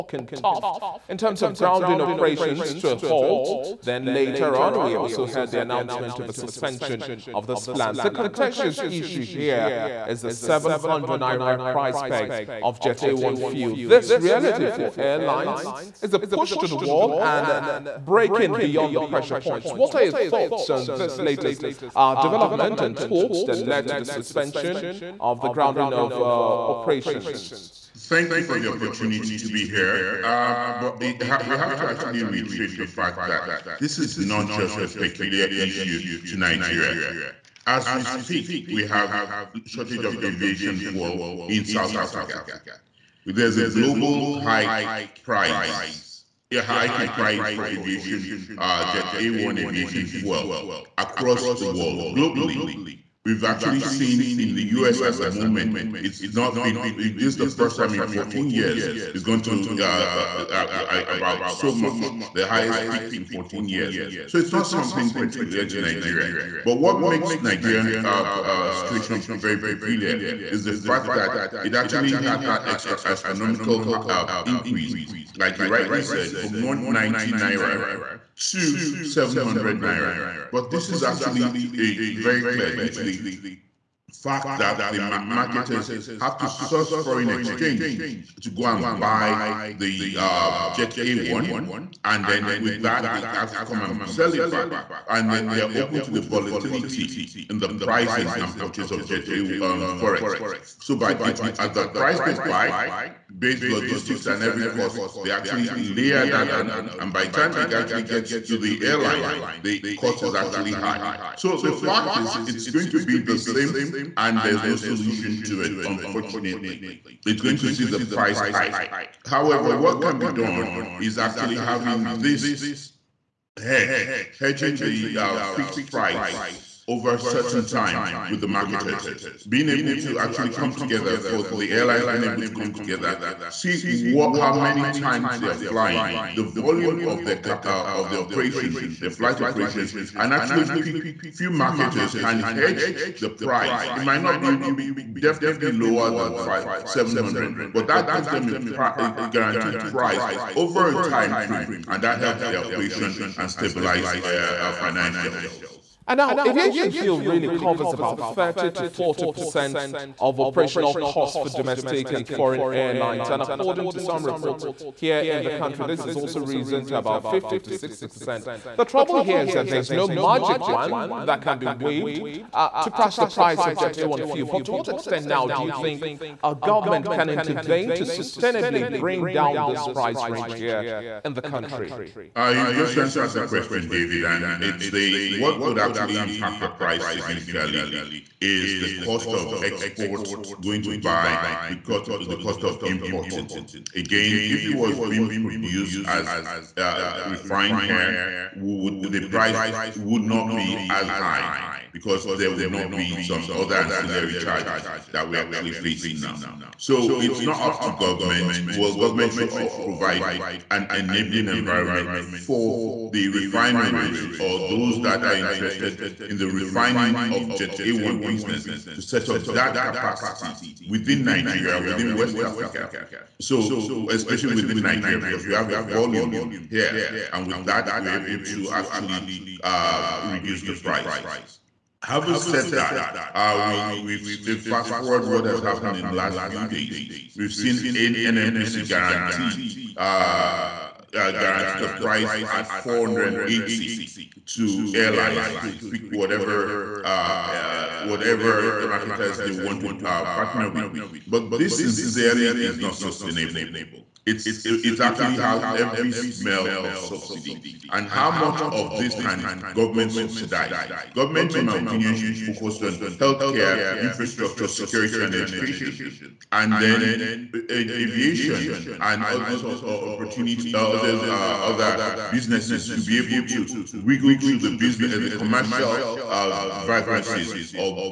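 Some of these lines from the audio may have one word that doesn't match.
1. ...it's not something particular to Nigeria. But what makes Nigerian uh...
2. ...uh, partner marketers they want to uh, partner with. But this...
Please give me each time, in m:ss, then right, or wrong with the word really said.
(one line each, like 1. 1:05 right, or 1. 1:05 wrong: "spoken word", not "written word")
1. 1:04 right
2. 4:07 wrong: "whatever", not "partner".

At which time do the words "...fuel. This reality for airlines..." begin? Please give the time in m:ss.
0:13.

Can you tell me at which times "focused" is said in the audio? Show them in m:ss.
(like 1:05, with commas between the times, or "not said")
4:22.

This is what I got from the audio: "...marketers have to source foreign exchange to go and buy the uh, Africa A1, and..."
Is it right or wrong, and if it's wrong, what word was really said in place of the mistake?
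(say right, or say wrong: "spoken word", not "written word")
wrong: "Jet", not "Africa".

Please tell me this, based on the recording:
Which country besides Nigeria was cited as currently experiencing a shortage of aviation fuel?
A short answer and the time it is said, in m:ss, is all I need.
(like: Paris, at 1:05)
South Africa, at 0:41.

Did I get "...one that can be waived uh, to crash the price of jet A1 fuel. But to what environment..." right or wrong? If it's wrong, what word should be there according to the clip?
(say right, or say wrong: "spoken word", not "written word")
wrong: "extent", not "environment".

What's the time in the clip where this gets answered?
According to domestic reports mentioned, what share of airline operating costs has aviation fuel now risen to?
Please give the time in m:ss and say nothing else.
2:47.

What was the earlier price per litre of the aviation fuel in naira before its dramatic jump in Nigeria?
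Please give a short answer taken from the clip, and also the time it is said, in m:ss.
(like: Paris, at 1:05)
190 naira, at 1:16.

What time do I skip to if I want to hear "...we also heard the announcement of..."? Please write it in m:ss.
0:04.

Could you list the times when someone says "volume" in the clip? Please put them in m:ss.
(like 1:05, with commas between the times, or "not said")
2:16, 3:45.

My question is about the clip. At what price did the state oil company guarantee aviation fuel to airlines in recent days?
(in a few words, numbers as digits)
480.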